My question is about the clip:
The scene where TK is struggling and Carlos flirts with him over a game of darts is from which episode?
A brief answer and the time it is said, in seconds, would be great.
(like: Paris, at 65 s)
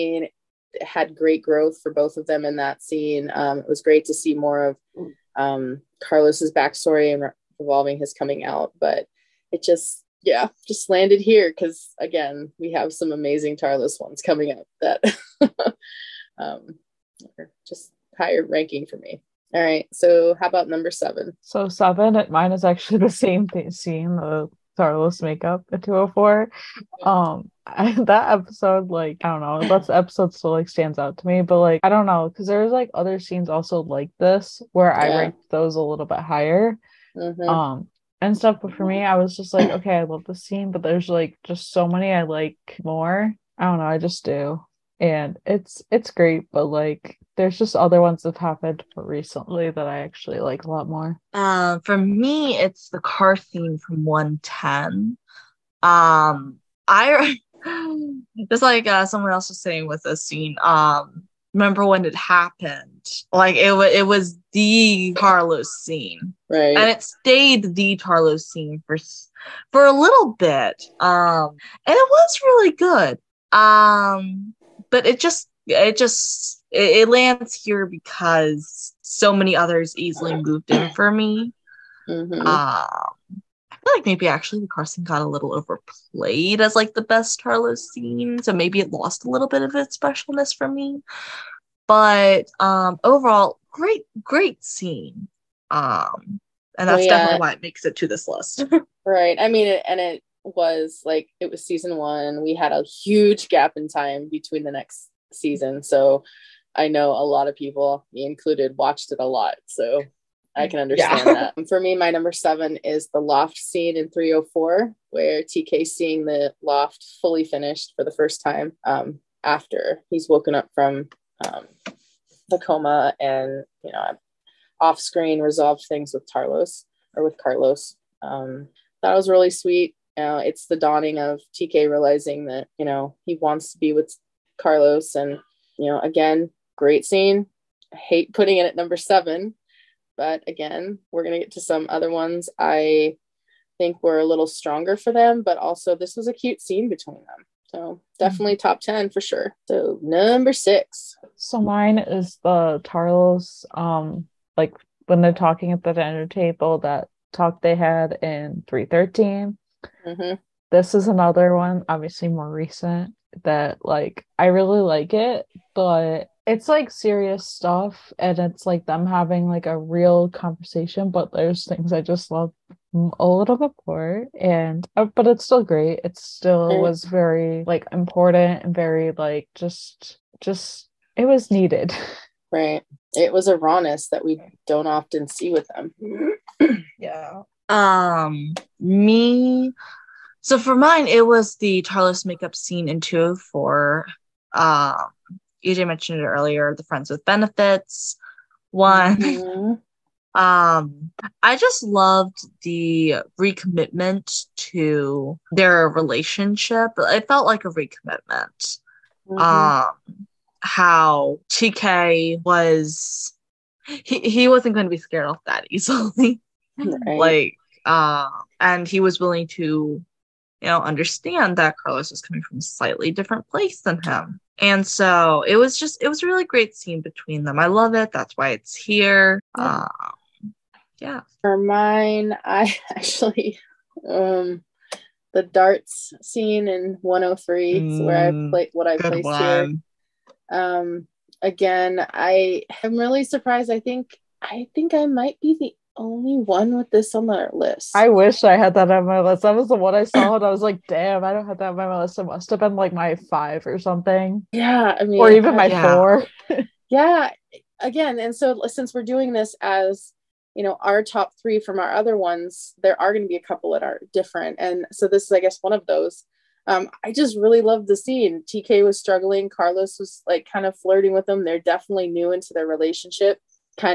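103, at 237 s.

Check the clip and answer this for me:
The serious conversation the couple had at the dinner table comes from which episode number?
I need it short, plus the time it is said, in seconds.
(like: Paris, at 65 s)
313, at 158 s.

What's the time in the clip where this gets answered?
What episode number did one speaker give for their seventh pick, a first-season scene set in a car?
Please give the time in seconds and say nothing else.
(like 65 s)
54 s.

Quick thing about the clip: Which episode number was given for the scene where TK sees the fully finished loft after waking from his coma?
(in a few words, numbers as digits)
304.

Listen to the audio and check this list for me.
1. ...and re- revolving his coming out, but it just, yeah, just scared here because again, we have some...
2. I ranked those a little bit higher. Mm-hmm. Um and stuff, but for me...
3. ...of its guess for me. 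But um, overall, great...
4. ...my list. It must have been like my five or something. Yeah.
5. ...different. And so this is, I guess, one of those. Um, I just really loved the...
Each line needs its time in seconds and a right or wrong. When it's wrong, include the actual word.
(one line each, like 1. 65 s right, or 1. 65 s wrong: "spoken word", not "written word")
1. 7 s wrong: "landed", not "scared"
2. 35 s right
3. 89 s wrong: "specialness", not "guess"
4. 251 s right
5. 264 s right.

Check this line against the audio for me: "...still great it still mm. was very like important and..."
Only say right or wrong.
right.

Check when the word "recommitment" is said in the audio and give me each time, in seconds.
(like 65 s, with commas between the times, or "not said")
203 s, 207 s.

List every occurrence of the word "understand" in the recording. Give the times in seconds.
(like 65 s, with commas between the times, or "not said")
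110 s, 220 s.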